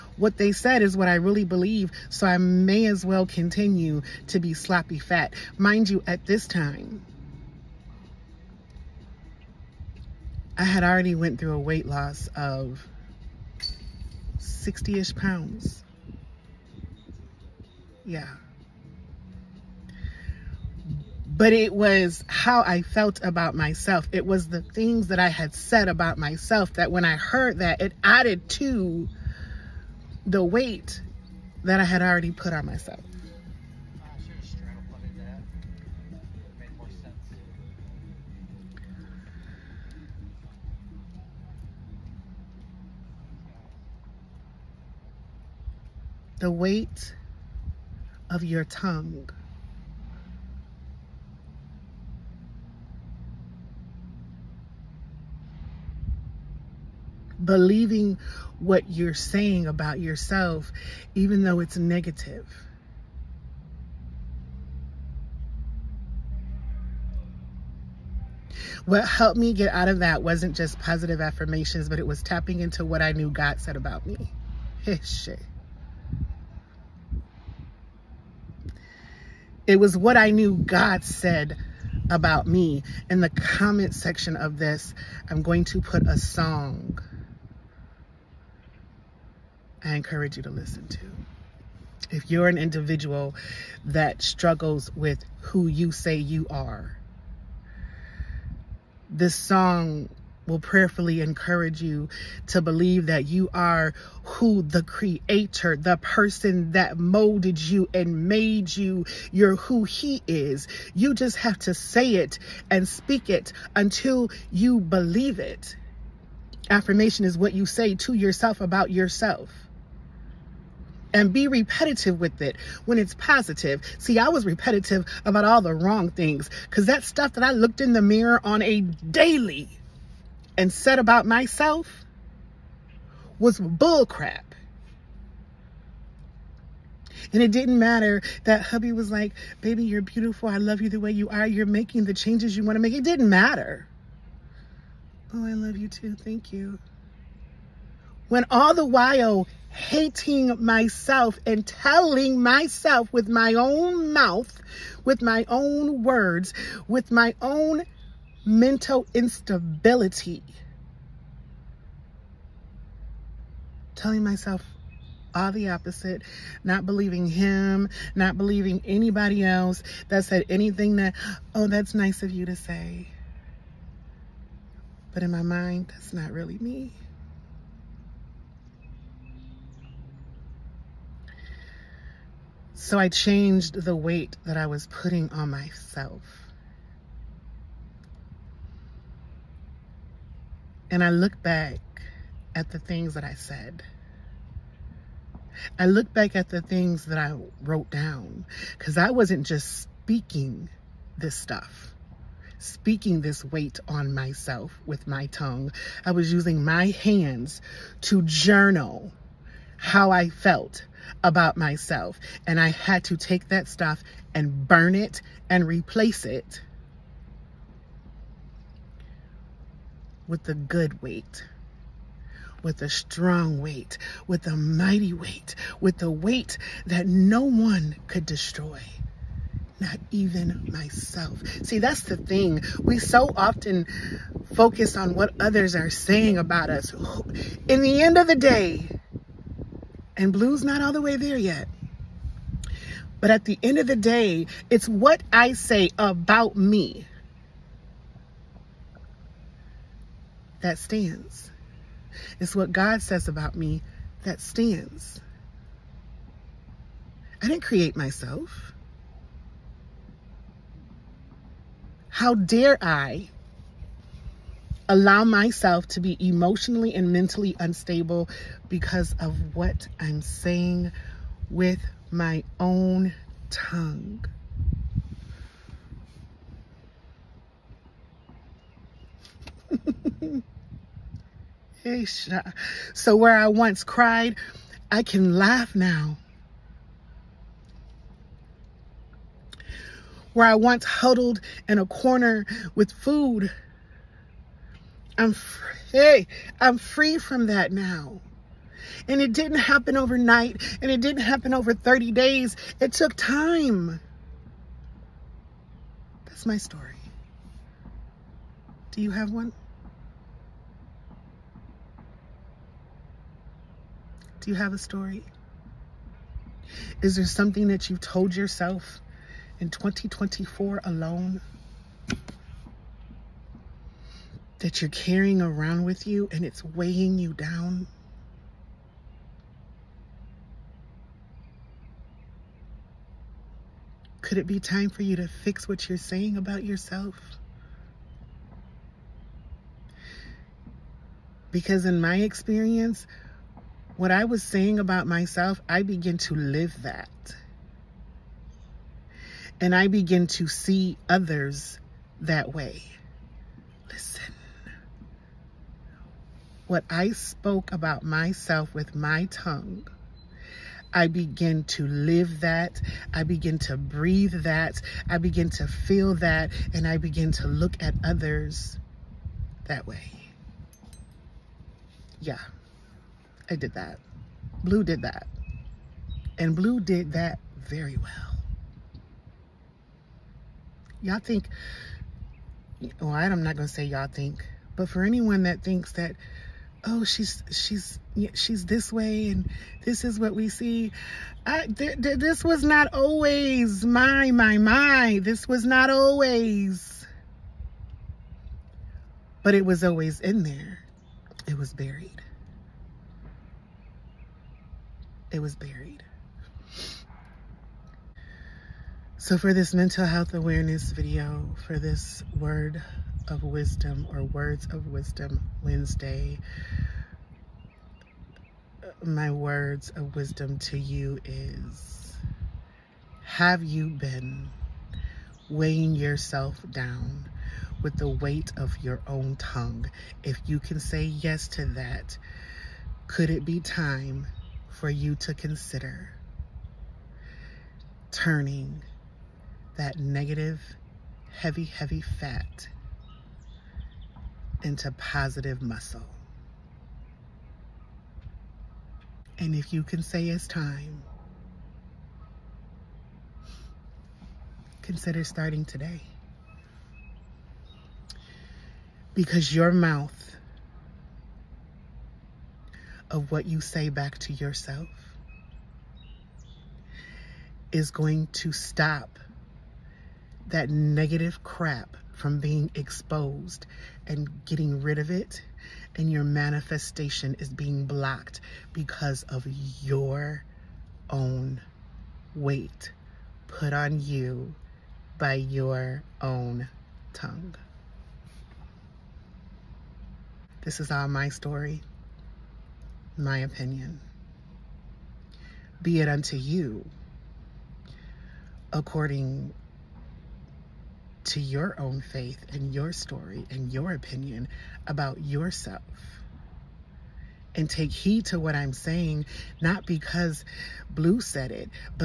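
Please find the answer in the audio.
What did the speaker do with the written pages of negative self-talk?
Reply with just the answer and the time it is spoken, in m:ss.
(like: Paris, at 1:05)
Burn it, at 3:34.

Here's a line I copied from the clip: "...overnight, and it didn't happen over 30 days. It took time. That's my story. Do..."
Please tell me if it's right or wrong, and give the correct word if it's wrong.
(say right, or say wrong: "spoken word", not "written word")
right.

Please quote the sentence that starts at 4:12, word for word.
It's what God says about me that stands.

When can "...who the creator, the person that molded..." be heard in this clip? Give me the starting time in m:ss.
1:44.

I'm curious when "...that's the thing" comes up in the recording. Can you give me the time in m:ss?
3:51.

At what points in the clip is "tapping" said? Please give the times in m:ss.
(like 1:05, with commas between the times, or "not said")
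1:12.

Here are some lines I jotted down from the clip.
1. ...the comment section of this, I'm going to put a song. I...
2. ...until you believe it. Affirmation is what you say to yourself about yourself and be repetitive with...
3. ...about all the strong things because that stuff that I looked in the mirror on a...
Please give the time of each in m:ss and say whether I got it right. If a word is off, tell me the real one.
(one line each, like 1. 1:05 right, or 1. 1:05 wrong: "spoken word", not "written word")
1. 1:23 right
2. 1:53 right
3. 2:05 wrong: "wrong", not "strong".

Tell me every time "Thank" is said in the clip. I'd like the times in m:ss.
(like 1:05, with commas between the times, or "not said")
2:26.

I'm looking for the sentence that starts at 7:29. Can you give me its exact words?
And if you can say it's time, consider starting today.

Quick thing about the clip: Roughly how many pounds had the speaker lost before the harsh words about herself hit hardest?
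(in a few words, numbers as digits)
60.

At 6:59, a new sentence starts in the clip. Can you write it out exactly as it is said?
My words of wisdom to you is Have you been weighing yourself down with the weight of your own tongue?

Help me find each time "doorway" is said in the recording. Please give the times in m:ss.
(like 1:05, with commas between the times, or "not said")
not said.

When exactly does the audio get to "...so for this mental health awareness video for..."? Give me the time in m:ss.
6:49.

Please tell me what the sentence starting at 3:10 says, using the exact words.
And I look back at the things that I said.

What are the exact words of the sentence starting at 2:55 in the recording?
But in my mind, that's not really me.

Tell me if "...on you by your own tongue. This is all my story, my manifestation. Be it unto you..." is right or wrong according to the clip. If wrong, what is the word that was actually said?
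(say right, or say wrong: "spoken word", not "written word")
wrong: "opinion", not "manifestation".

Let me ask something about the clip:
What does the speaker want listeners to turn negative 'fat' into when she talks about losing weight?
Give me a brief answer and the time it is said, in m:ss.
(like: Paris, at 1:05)
Positive muscle, at 7:24.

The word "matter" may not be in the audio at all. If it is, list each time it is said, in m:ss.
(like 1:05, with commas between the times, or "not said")
2:17, 2:23.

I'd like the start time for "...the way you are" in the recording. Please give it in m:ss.
2:20.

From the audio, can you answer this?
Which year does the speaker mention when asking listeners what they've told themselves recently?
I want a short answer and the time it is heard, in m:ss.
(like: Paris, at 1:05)
2024, at 5:19.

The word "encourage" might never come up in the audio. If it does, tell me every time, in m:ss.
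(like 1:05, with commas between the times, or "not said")
1:29, 1:41.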